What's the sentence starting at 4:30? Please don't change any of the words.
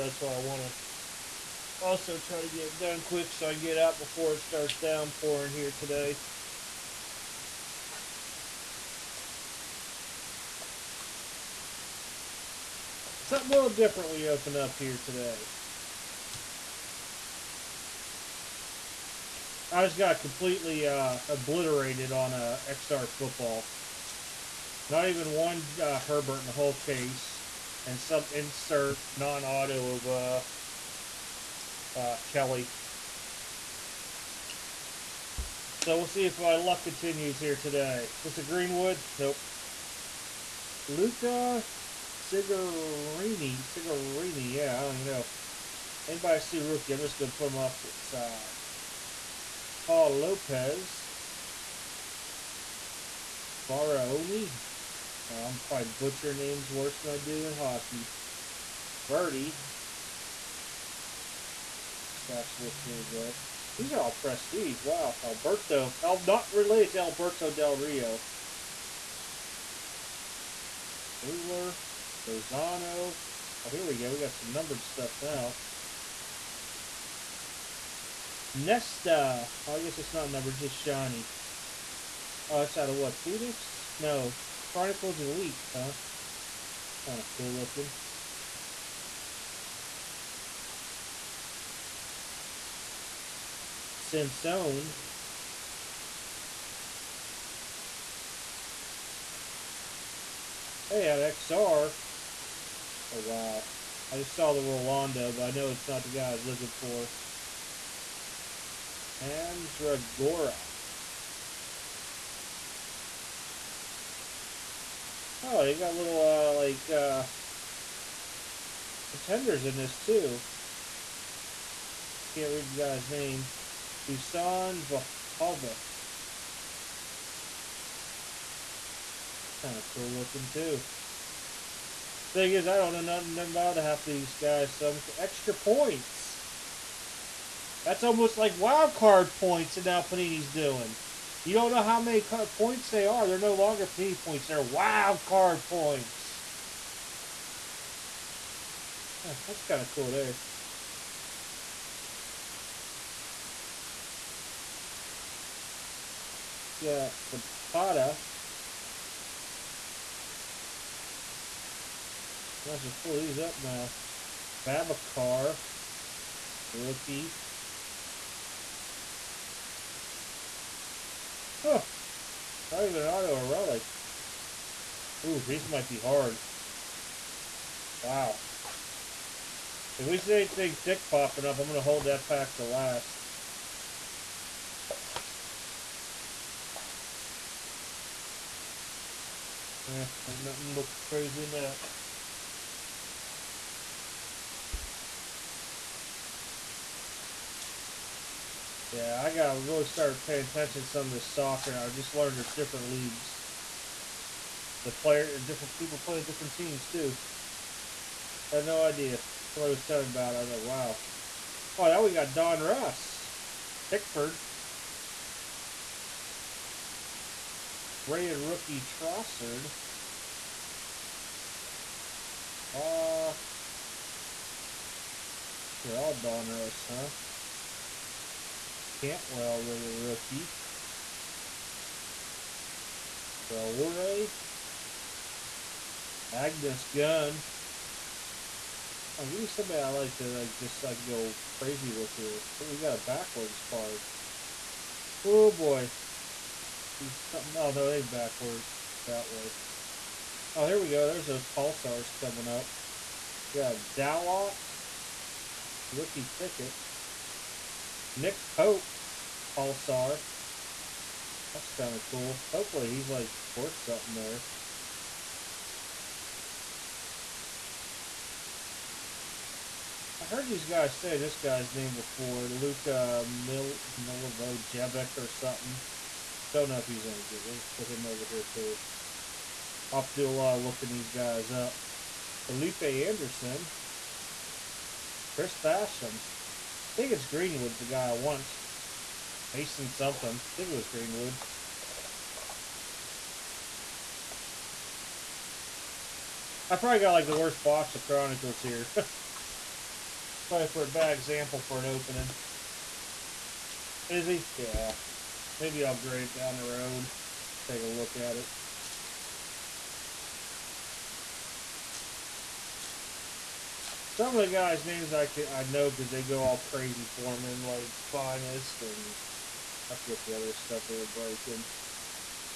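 I heard these guys say this guy's name before, Luka Mil- or something.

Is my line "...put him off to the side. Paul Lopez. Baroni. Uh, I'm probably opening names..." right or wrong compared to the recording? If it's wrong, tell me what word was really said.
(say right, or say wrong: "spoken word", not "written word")
wrong: "butchering", not "opening".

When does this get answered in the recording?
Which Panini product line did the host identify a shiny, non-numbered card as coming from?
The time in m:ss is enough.
1:24.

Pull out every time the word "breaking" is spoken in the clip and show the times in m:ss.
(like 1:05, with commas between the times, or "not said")
5:21.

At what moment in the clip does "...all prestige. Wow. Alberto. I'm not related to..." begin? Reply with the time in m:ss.
1:04.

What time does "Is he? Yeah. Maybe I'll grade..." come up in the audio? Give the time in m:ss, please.
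5:04.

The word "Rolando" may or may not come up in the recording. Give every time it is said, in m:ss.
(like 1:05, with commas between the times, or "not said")
1:44.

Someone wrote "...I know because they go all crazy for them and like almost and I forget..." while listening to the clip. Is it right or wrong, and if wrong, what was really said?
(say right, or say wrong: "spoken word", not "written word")
wrong: "finest", not "almost".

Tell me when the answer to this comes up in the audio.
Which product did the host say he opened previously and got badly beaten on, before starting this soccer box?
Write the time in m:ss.
0:22.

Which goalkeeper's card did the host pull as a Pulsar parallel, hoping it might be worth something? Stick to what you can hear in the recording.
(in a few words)
Nick Pope.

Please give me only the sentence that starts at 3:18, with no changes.
Yeah, I gotta really start paying attention to some of this soccer, and I just learned there's different leagues.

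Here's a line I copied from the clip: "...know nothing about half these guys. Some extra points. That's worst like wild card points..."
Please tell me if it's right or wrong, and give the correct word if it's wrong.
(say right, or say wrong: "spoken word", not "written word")
wrong: "almost", not "worst".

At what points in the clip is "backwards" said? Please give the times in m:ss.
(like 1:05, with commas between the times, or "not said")
4:02, 4:08.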